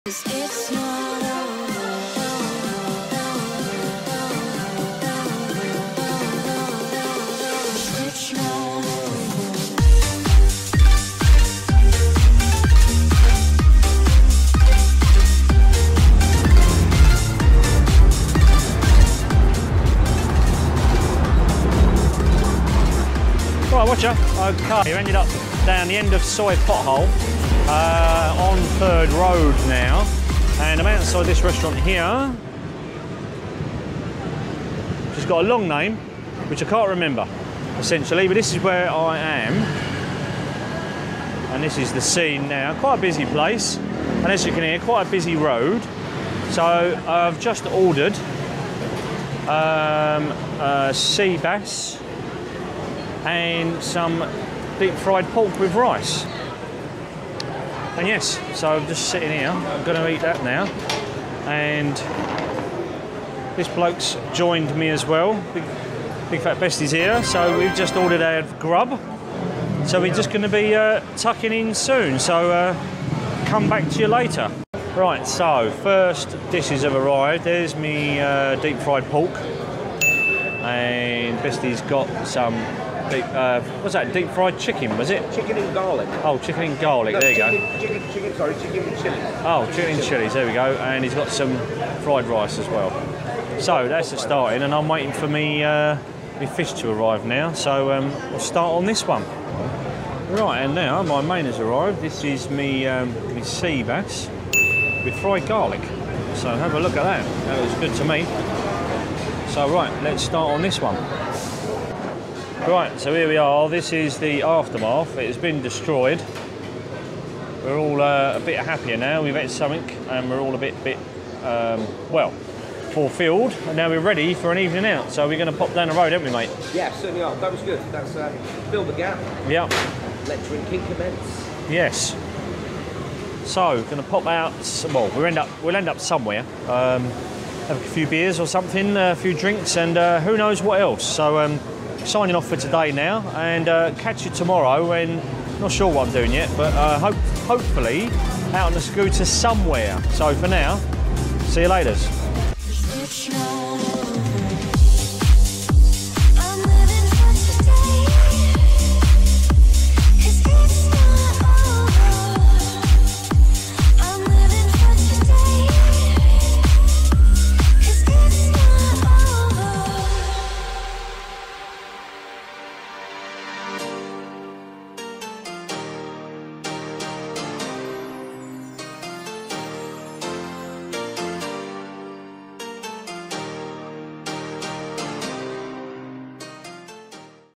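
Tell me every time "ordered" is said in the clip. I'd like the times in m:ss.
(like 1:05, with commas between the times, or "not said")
0:47, 1:07.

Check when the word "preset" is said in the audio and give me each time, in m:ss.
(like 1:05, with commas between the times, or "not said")
not said.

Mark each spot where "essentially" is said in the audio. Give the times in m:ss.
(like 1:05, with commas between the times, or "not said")
0:37.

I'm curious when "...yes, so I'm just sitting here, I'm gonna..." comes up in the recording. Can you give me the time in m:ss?
0:58.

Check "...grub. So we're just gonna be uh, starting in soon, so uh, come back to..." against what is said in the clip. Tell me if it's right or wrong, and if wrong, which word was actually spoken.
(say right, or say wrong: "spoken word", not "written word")
wrong: "tucking", not "starting".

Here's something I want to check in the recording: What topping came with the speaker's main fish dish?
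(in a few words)
Fried garlic.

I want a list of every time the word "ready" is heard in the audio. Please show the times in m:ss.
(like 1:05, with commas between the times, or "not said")
2:03.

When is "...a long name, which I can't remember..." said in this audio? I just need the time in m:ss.
0:35.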